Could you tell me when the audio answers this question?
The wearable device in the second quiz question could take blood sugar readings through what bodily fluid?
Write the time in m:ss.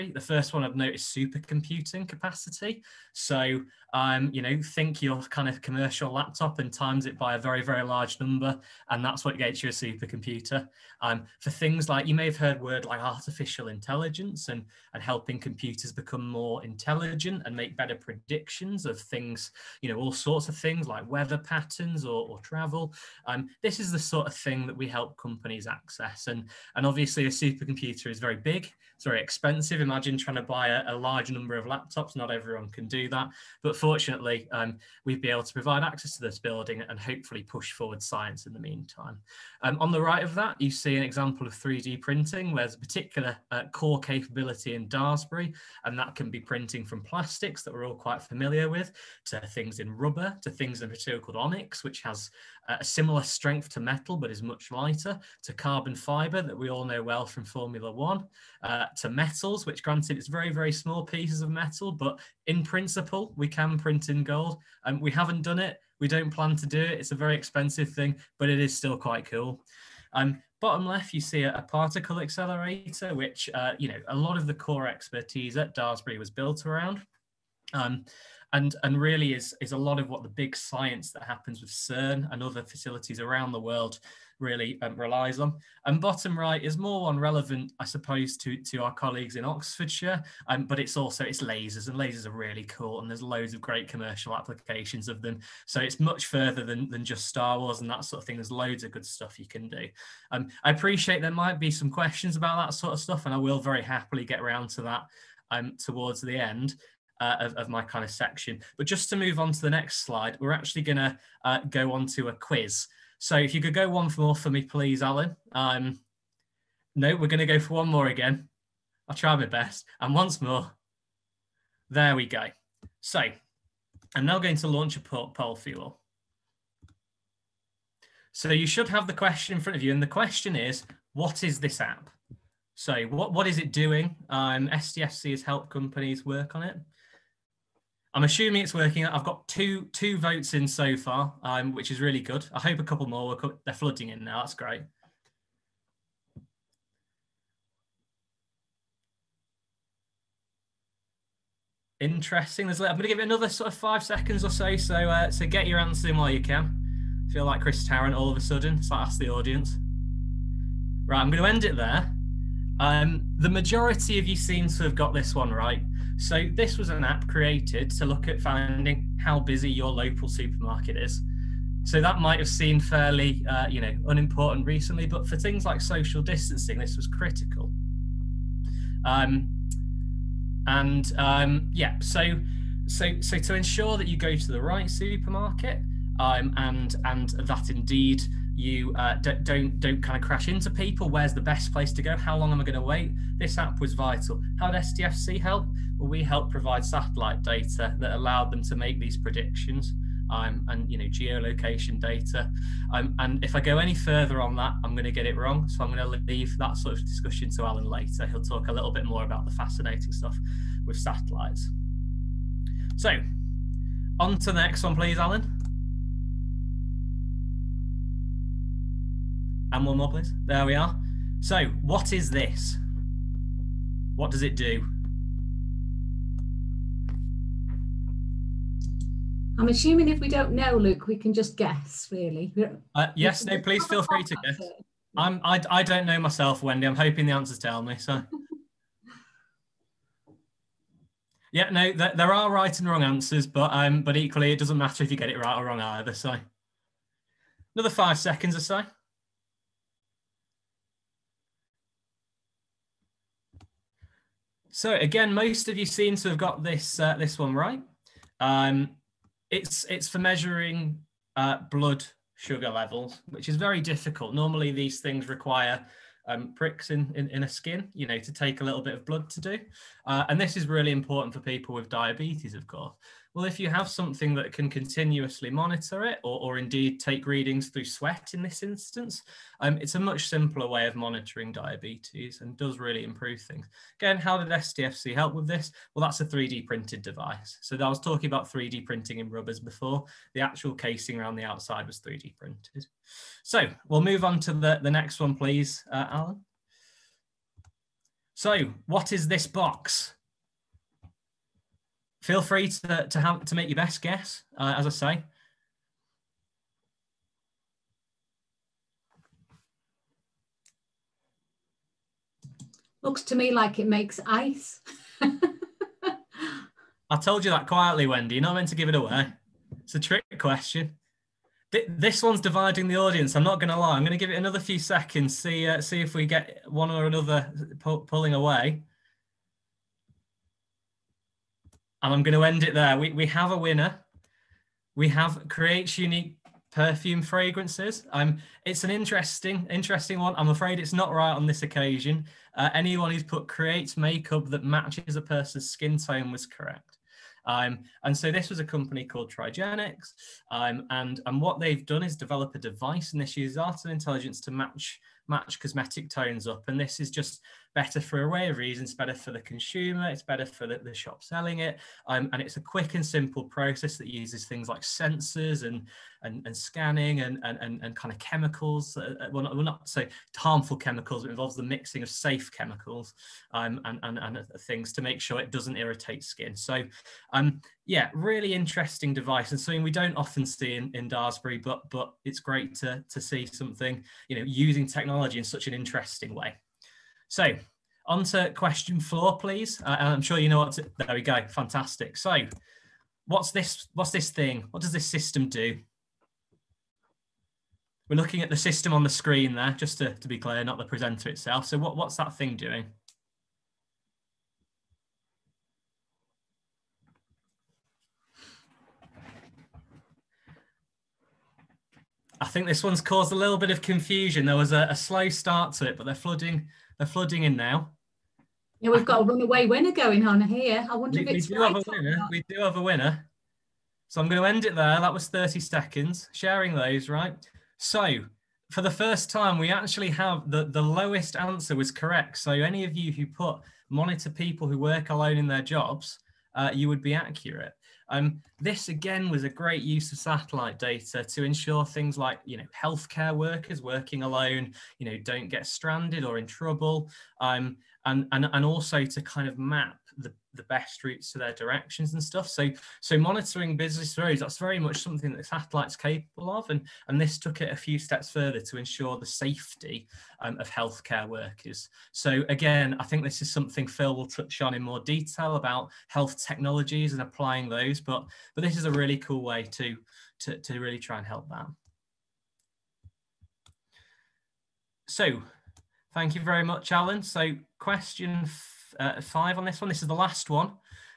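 4:37.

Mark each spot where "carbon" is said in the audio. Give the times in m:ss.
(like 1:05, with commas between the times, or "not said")
0:55.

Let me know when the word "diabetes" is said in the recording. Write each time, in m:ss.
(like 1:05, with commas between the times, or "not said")
4:31, 4:41.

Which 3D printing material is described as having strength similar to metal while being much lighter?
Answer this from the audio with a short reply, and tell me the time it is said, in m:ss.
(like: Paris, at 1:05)
Onyx, at 0:51.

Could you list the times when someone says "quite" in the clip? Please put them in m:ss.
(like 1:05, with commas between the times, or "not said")
0:47, 1:08.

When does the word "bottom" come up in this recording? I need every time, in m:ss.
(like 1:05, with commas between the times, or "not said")
1:10, 1:25.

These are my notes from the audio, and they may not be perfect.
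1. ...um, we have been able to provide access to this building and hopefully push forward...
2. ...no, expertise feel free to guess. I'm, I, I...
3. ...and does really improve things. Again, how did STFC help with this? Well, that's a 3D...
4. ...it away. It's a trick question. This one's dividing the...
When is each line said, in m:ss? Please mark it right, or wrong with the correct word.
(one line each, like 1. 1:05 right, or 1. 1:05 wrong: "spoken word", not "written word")
1. 0:34 right
2. 3:53 wrong: "please", not "expertise"
3. 4:42 right
4. 5:18 right.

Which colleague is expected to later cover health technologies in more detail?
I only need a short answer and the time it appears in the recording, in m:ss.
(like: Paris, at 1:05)
Phil, at 7:43.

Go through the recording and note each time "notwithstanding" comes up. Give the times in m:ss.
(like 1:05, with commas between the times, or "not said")
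not said.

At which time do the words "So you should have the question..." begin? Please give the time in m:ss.
2:08.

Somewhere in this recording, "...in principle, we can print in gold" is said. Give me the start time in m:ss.
1:02.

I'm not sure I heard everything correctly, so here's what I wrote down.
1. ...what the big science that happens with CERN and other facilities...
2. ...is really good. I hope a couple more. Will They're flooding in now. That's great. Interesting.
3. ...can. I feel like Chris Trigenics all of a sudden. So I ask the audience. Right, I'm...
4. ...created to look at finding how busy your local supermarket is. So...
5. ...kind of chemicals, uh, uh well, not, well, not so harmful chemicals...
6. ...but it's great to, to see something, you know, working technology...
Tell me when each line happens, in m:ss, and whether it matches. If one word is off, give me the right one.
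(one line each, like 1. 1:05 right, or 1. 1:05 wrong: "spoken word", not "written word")
1. 1:20 right
2. 2:21 right
3. 2:36 wrong: "Tarrant", not "Trigenics"
4. 2:47 right
5. 6:07 right
6. 6:21 wrong: "using", not "working".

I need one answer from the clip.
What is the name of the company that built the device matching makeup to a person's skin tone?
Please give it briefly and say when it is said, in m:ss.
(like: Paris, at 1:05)
Trigenics, at 5:49.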